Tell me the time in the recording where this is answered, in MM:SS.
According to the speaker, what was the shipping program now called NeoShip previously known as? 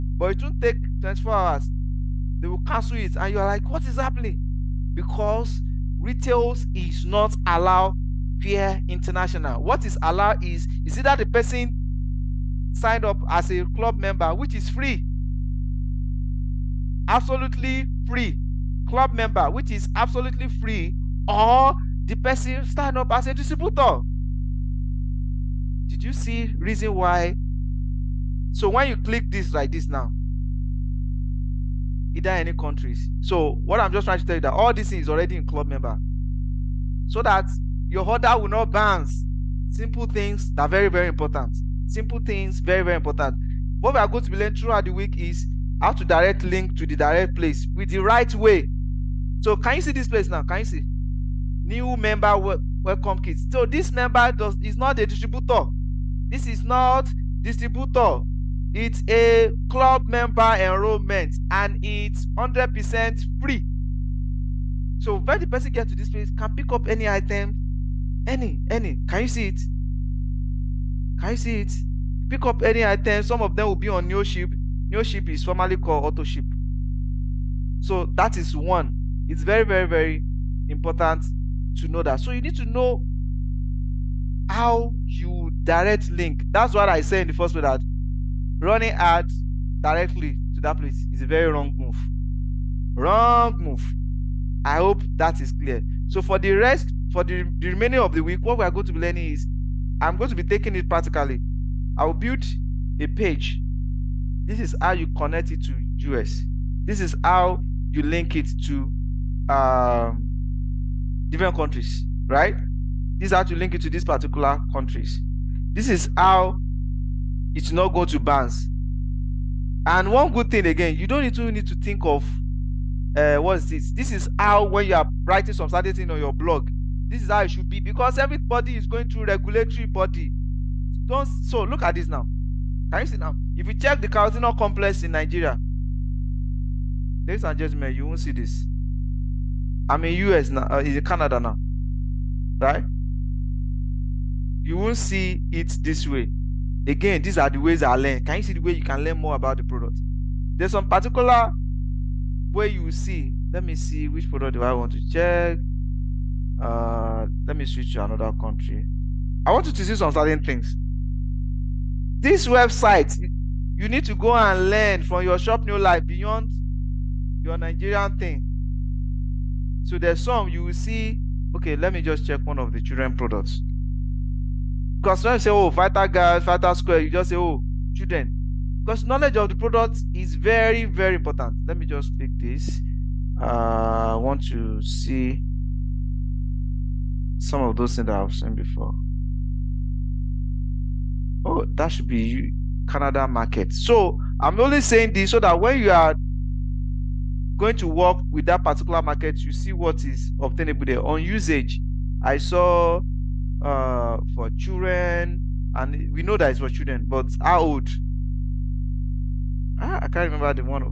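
01:16.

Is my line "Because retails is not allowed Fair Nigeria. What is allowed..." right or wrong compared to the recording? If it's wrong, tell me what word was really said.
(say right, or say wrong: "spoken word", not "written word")
wrong: "International", not "Nigeria".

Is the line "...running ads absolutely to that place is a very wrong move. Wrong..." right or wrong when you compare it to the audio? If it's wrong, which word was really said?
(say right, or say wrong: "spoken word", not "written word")
wrong: "directly", not "absolutely".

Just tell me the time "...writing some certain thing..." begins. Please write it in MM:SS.
02:05.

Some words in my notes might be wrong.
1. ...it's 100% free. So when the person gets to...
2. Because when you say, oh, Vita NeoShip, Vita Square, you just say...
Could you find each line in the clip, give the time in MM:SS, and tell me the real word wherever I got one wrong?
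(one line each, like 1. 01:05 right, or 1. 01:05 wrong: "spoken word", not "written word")
1. 01:01 right
2. 02:55 wrong: "Guard", not "NeoShip".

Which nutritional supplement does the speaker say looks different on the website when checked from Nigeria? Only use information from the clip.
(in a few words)
carotenoid complex.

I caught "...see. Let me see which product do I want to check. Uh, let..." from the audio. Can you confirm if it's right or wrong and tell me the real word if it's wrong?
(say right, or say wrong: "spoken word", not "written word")
right.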